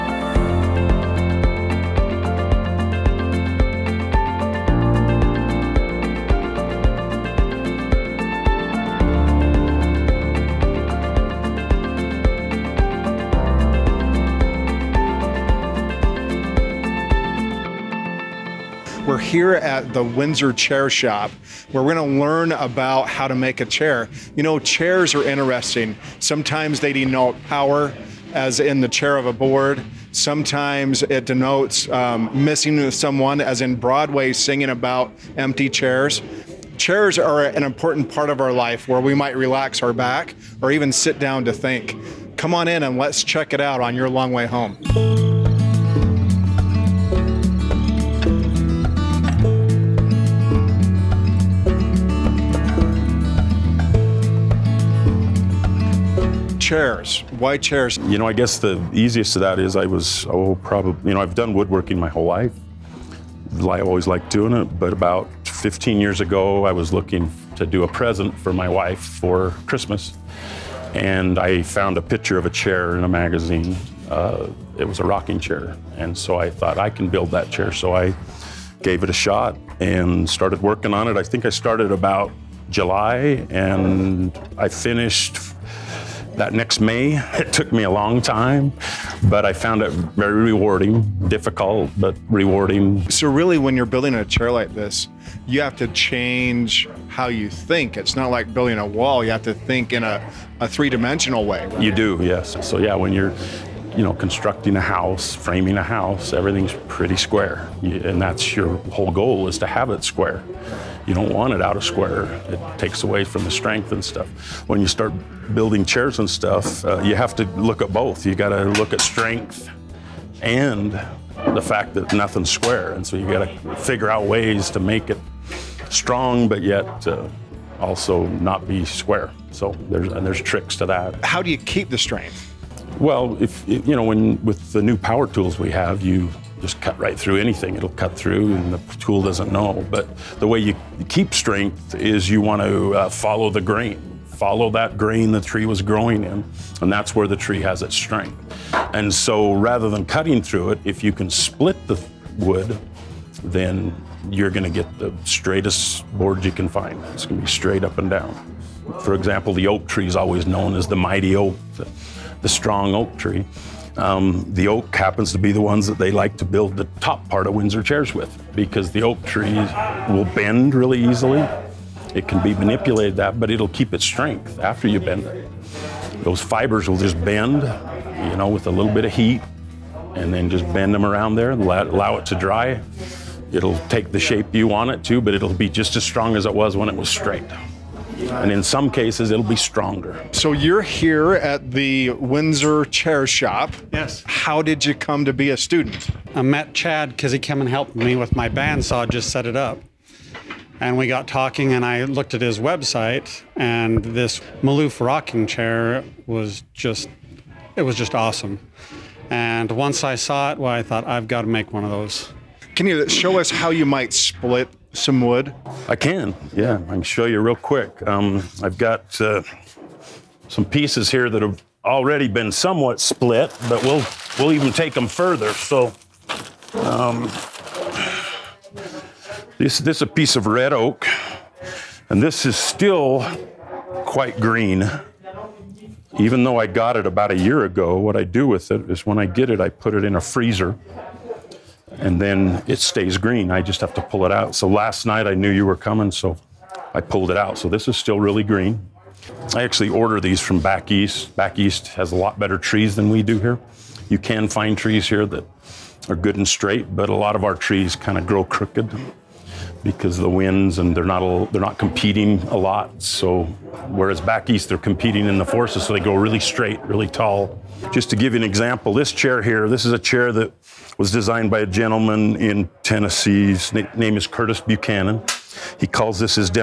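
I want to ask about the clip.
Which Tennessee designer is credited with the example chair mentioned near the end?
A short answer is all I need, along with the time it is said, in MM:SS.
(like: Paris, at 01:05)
Curtis Buchanan, at 04:34.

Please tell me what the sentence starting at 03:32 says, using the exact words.
Can you show us how you might split some wood?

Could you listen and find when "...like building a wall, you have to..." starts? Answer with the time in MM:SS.
01:38.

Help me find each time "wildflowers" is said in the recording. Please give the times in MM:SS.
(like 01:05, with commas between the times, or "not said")
not said.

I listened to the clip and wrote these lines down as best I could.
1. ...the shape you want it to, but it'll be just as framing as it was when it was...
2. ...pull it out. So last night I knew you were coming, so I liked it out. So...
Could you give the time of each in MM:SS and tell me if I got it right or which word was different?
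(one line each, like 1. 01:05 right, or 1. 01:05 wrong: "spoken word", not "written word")
1. 03:04 wrong: "strong", not "framing"
2. 04:04 wrong: "pulled", not "liked".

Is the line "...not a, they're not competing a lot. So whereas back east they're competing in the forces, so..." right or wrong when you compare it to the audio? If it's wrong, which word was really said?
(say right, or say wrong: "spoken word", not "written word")
right.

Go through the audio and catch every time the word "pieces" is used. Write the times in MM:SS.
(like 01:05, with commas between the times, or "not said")
03:40, 03:50.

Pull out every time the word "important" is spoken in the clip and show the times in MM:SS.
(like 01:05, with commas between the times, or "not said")
00:37.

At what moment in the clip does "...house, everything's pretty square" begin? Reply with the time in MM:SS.
01:45.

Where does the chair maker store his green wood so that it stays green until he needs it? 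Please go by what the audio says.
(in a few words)
In a freezer.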